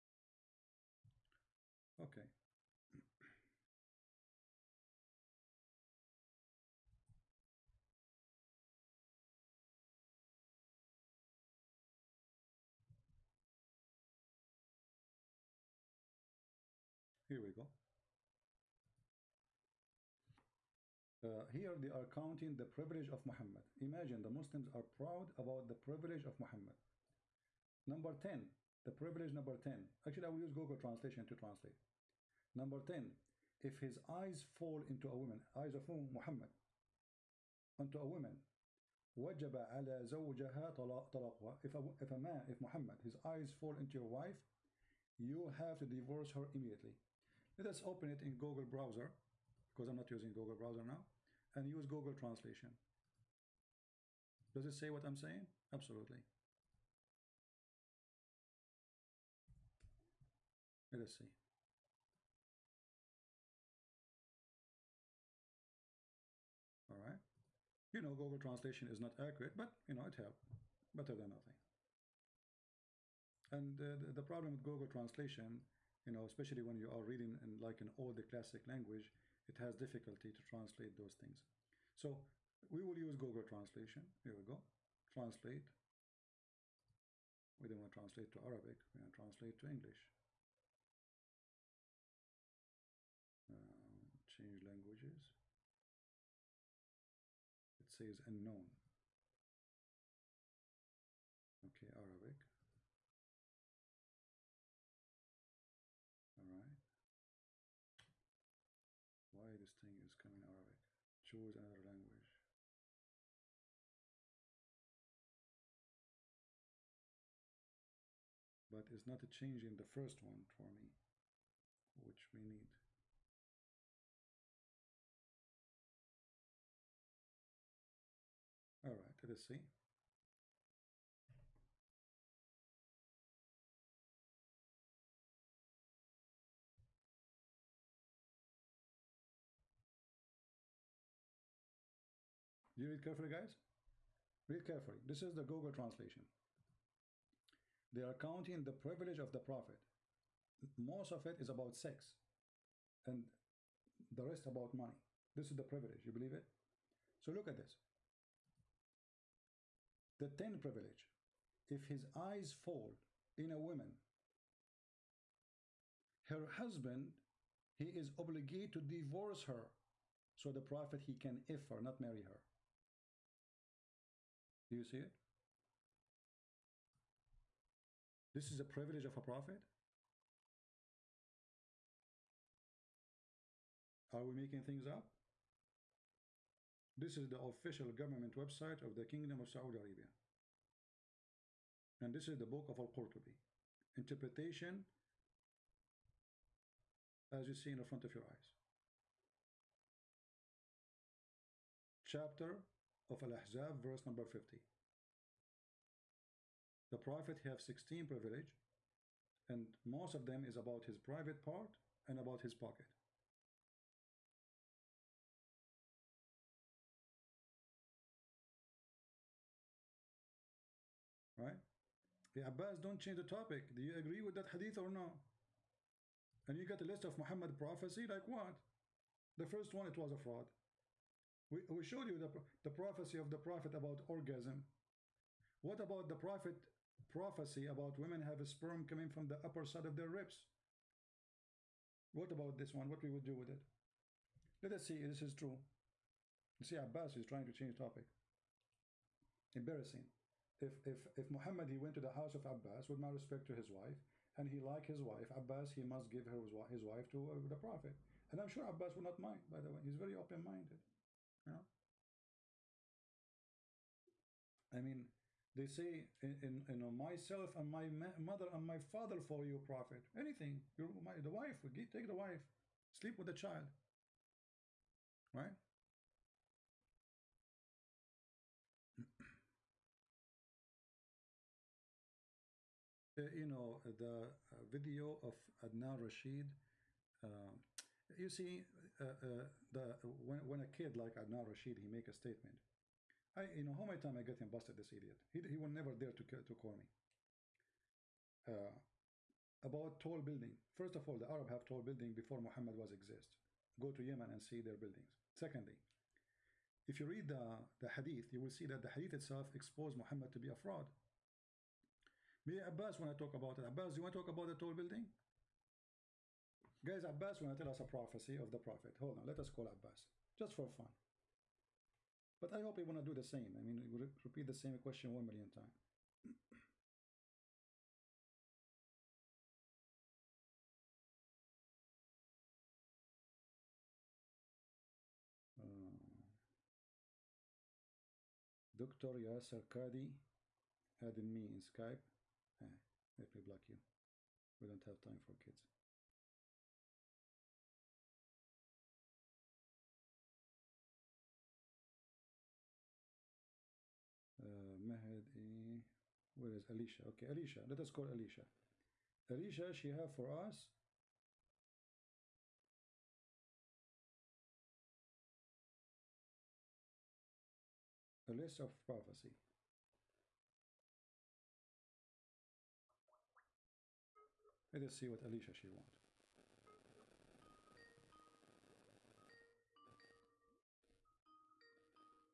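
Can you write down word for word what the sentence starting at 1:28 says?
We want to translate to English.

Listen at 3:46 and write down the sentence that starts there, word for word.
And you got a list of Muhammad prophecy, like what?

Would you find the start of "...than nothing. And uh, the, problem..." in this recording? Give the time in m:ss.
1:11.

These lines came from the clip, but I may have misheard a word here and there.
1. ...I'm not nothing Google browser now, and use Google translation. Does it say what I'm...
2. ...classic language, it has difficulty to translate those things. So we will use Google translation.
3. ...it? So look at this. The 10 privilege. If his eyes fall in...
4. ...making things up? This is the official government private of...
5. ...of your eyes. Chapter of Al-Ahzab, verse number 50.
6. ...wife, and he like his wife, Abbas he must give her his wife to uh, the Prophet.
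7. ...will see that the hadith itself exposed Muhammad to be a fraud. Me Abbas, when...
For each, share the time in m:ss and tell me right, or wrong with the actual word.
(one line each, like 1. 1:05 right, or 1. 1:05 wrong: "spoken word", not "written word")
1. 0:49 wrong: "using", not "nothing"
2. 1:18 right
3. 2:36 right
4. 3:04 wrong: "website", not "private"
5. 3:18 right
6. 4:13 right
7. 5:08 right.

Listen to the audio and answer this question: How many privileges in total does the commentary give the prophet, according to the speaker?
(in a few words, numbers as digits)
16.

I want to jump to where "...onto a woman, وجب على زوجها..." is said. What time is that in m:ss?
0:37.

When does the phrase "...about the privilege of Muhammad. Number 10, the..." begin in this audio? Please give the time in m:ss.
0:25.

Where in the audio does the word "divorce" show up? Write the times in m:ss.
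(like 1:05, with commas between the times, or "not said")
0:45, 2:48.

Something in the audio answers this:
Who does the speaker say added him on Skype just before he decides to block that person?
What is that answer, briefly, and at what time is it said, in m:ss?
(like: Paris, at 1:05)
Dr. Yasser Kadi, at 5:38.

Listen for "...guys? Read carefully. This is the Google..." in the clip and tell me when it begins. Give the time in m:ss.
2:23.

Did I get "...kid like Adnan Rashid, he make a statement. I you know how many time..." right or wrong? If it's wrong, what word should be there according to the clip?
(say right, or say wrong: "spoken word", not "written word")
right.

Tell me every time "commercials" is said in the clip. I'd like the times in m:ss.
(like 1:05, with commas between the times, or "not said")
not said.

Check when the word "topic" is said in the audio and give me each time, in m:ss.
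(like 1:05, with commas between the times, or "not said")
3:43, 4:07.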